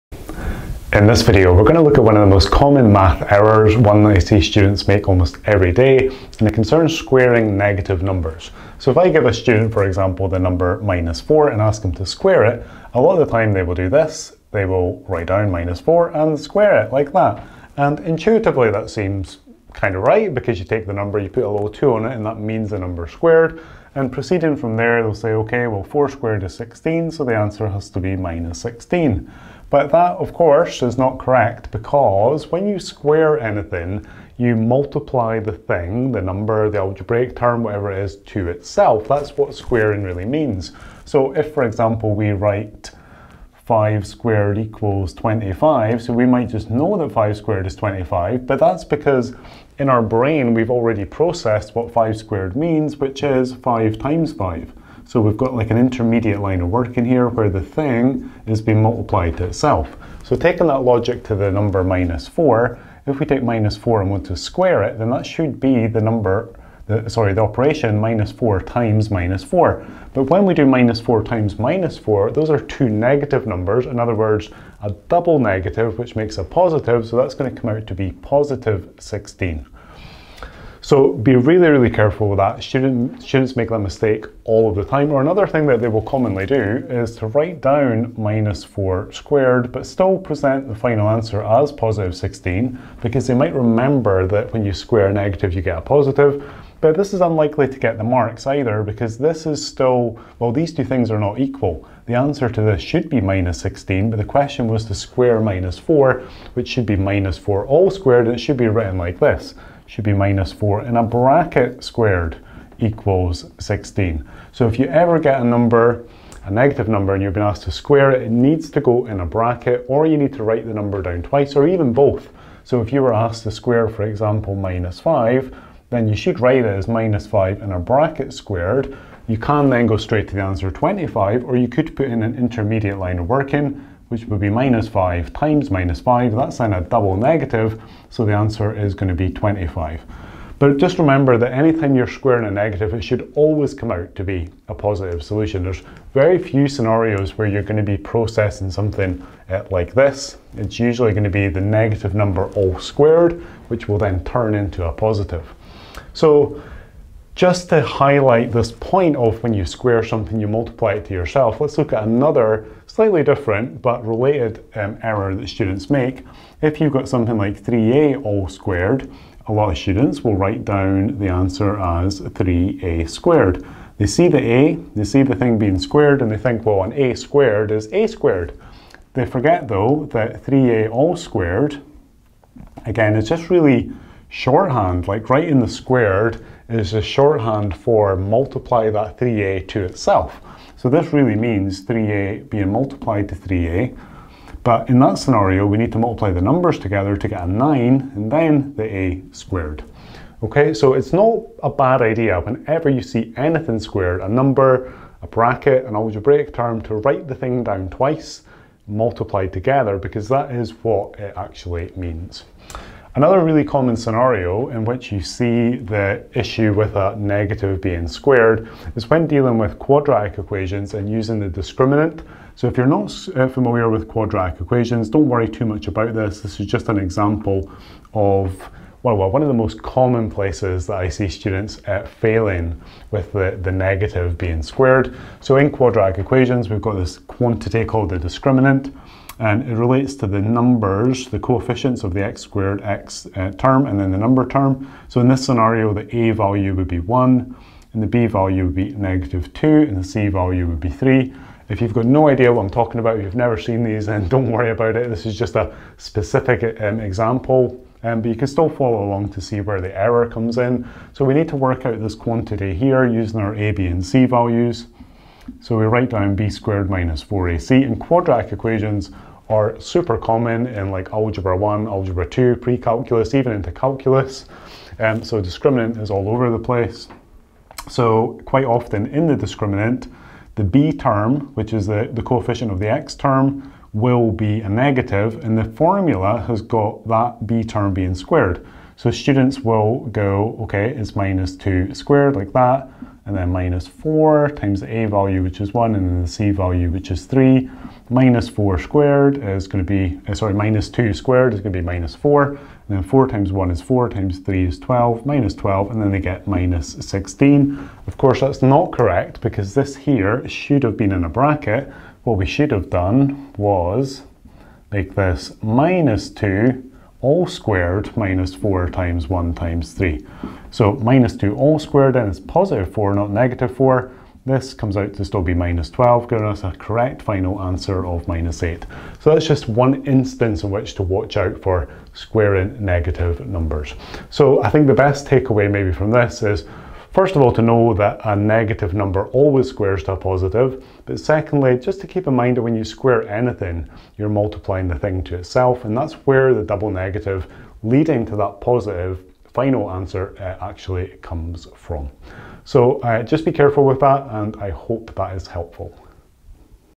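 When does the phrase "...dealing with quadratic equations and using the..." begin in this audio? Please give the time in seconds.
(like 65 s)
219 s.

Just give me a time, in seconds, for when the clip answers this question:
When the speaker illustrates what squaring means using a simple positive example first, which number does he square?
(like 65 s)
43 s.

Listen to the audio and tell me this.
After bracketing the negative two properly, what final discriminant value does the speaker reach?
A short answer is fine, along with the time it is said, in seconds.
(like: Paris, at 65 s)
-8, at 328 s.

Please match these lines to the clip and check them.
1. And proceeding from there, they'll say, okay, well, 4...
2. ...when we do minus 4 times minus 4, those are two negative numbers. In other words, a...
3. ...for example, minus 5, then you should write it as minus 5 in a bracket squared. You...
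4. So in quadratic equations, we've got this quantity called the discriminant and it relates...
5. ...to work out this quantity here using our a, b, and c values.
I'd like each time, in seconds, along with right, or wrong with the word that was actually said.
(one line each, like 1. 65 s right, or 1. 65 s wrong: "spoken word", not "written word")
1. 23 s right
2. 70 s right
3. 123 s right
4. 235 s right
5. 261 s right.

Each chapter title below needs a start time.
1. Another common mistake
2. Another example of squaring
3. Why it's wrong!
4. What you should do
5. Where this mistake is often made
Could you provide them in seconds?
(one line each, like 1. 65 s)
1. 87 s
2. 160 s
3. 33 s
4. 60 s
5. 212 s.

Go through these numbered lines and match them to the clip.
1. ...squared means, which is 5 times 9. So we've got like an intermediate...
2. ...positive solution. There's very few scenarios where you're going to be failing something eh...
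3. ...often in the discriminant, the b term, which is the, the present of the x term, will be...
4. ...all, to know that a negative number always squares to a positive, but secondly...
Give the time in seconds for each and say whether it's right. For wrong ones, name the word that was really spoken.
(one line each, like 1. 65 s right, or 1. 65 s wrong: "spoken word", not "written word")
1. 52 s wrong: "5", not "9"
2. 144 s wrong: "processing", not "failing"
3. 278 s wrong: "coefficient", not "present"
4. 337 s right.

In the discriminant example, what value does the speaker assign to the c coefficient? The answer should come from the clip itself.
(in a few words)
3.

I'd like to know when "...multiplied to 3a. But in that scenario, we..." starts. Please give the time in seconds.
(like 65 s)
192 s.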